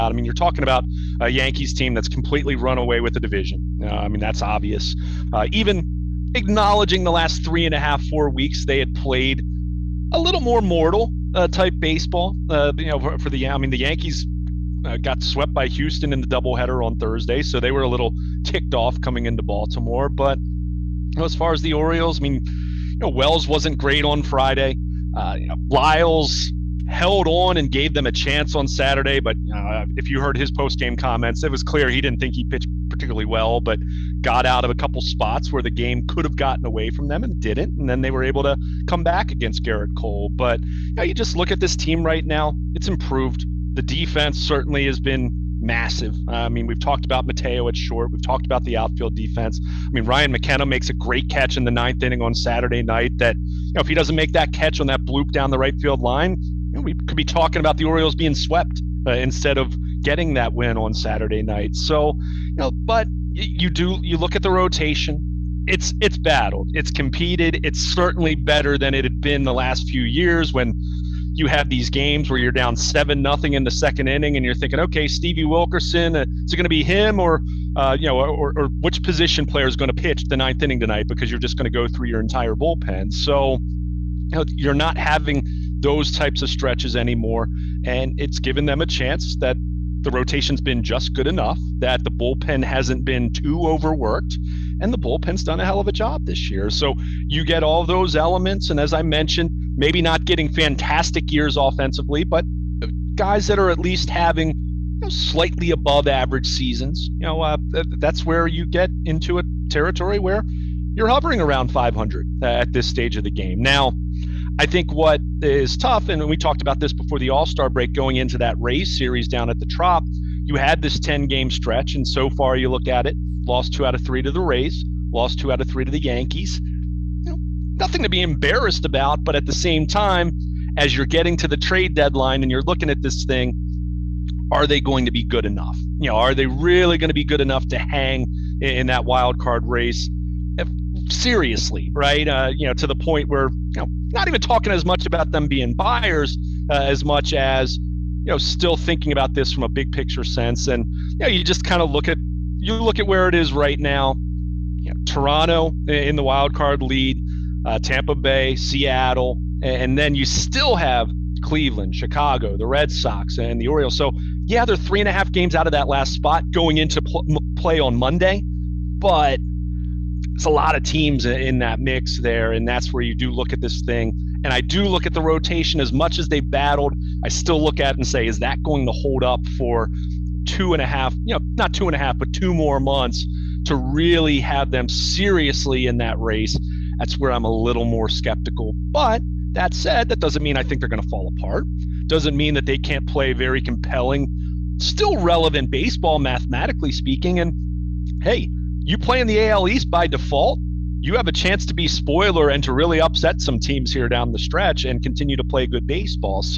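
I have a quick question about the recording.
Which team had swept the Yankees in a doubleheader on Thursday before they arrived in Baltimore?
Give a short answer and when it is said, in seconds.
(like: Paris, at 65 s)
Houston, at 15 s.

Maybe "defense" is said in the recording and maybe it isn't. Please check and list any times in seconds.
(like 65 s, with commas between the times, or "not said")
43 s, 49 s.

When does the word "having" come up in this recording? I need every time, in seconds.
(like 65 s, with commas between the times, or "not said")
84 s, 104 s.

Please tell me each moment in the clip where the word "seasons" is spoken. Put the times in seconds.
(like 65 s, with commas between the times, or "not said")
106 s.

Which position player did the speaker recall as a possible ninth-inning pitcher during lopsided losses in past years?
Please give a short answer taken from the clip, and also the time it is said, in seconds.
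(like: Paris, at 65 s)
Stevie Wilkerson, at 75 s.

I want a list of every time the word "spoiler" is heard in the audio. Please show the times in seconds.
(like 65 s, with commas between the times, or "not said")
201 s.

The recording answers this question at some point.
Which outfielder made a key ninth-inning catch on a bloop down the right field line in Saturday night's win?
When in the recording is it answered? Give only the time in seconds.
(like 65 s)
50 s.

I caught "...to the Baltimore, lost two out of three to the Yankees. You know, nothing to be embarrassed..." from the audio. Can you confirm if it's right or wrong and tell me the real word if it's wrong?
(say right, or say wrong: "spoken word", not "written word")
wrong: "Rays", not "Baltimore".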